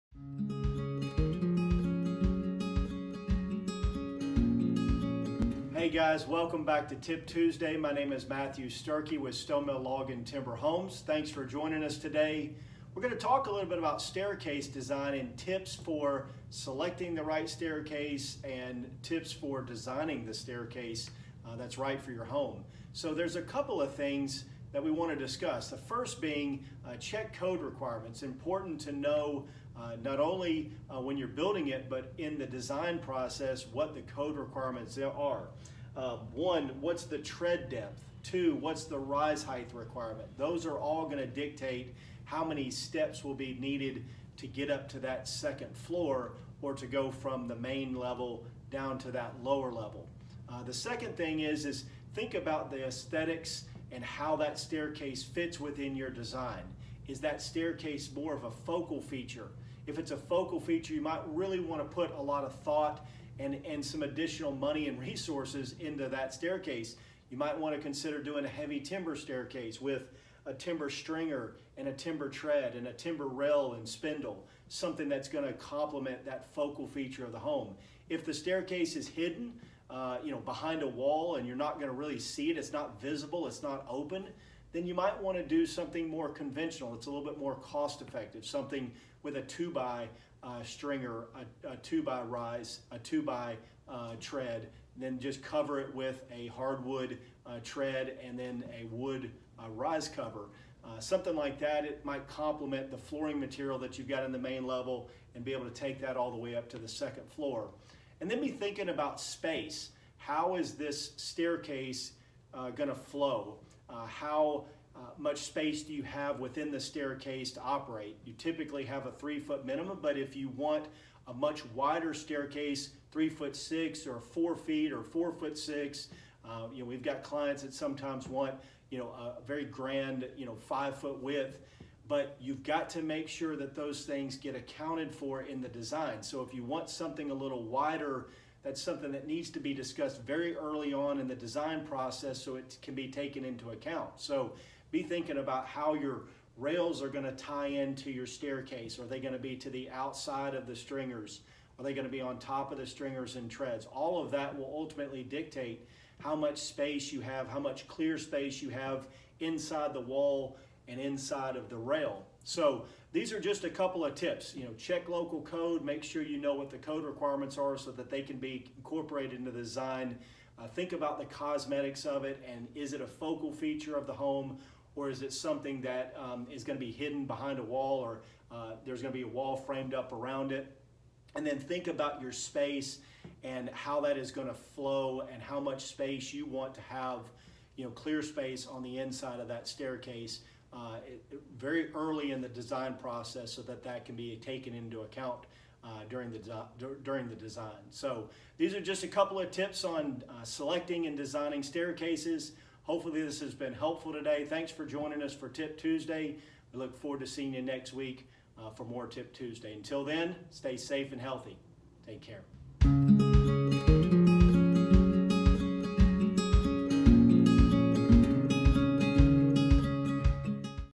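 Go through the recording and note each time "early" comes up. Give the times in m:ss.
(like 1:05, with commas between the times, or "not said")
2:20, 3:11.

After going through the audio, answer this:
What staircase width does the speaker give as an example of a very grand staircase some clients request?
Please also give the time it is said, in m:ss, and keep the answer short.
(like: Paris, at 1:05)
5 foot, at 2:10.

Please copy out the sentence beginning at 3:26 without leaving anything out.
We look forward to seeing you next week uh, for more Tip Tuesday.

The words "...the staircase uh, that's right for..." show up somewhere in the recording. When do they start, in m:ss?
0:20.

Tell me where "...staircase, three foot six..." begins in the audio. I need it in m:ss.
2:02.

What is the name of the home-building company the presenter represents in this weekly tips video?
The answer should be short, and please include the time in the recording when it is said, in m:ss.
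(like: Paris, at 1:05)
Stonemill Log and Timber Homes, at 0:09.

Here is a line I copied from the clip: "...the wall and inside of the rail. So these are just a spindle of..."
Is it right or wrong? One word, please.
wrong.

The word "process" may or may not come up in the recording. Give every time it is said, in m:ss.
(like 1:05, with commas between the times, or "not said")
0:32, 2:21, 3:13.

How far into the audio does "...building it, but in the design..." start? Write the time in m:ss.
0:31.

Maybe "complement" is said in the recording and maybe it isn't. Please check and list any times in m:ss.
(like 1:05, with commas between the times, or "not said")
1:15, 1:42.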